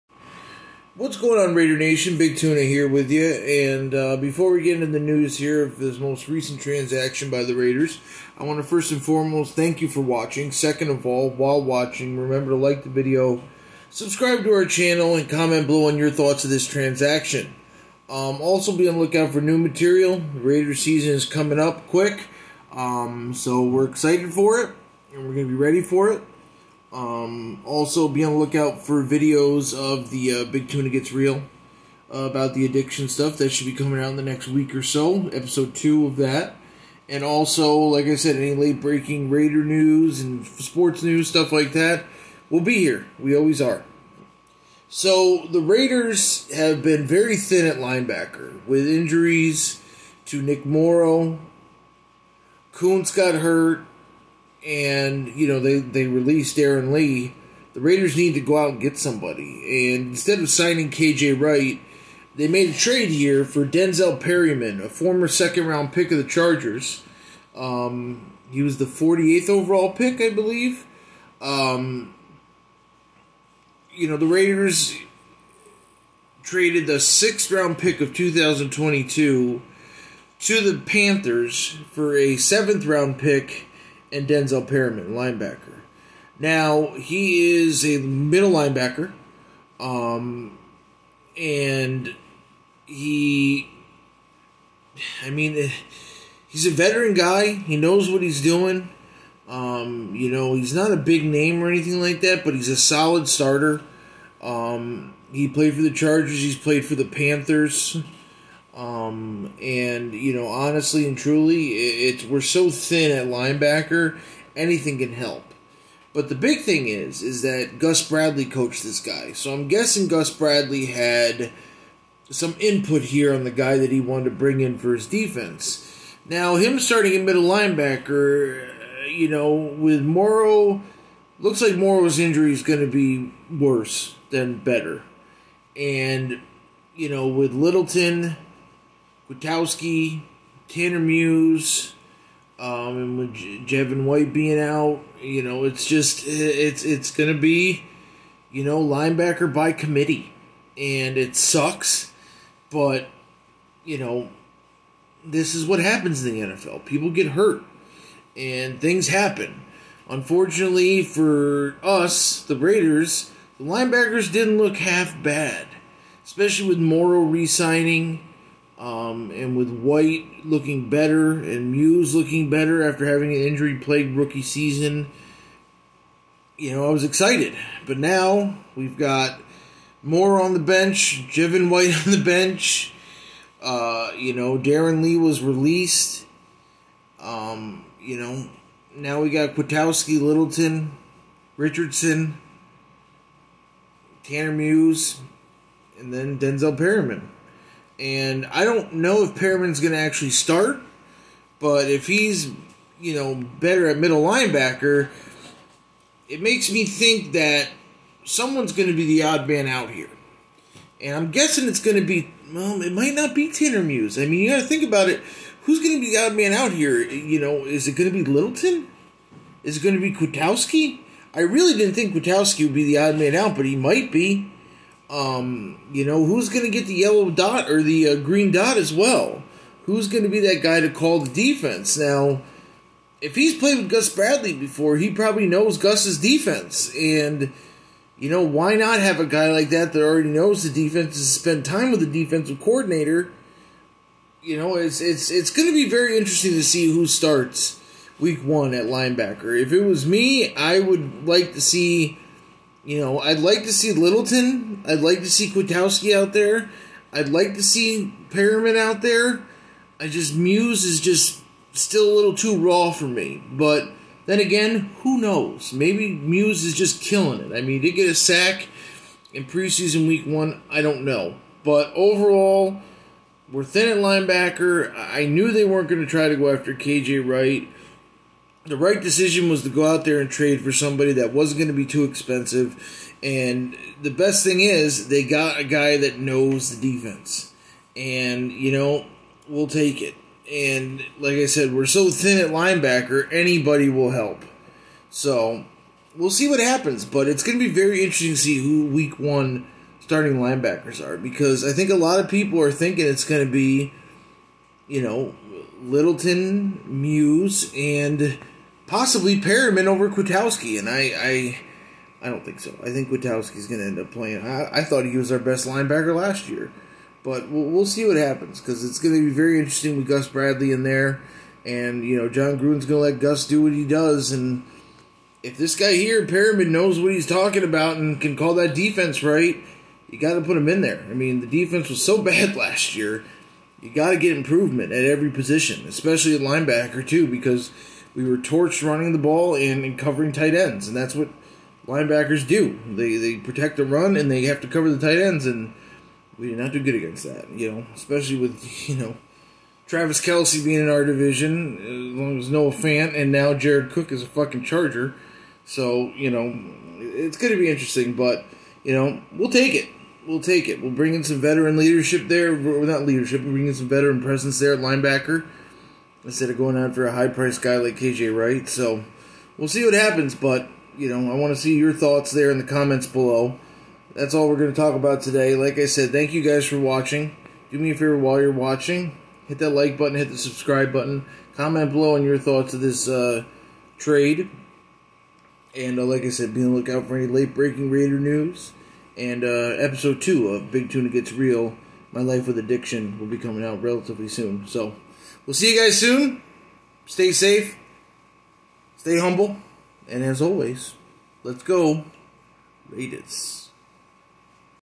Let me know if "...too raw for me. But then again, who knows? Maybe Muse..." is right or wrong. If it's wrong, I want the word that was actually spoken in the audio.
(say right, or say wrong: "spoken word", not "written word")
right.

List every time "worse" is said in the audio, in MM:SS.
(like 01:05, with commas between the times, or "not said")
02:13.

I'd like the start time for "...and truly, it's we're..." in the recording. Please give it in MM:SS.
01:51.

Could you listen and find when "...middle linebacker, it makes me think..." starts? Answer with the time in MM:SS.
03:23.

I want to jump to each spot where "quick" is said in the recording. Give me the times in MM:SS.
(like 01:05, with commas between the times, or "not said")
00:21.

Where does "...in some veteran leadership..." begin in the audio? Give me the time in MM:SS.
06:01.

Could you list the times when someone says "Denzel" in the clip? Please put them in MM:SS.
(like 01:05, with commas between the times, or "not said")
01:03, 01:24, 03:16.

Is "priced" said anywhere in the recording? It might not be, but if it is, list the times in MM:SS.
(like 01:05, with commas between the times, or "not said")
06:07.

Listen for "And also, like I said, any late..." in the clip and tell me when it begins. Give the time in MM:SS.
00:37.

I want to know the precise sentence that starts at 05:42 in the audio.
They they protect the run and they have to cover the tight ends, and we did not do good against that.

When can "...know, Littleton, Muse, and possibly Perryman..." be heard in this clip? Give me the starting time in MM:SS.
05:05.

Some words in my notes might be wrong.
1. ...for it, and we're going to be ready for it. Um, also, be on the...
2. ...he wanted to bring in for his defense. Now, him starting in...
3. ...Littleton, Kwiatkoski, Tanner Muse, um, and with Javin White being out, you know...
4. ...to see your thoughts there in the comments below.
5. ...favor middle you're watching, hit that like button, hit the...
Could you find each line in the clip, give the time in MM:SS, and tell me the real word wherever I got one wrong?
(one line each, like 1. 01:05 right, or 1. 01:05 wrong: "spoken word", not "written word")
1. 00:24 right
2. 02:03 right
3. 02:17 right
4. 06:11 right
5. 06:17 wrong: "while", not "middle".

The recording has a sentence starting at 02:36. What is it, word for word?
People get hurt, and things happen.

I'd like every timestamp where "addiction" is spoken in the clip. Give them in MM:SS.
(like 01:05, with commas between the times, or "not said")
00:32, 06:32.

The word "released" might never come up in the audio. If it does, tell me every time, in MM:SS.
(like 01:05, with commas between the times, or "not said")
00:56, 03:05.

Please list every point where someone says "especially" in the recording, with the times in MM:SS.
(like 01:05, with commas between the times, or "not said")
02:46, 05:35, 05:47.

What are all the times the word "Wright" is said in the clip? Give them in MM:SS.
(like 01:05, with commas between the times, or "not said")
01:01, 04:37, 06:08.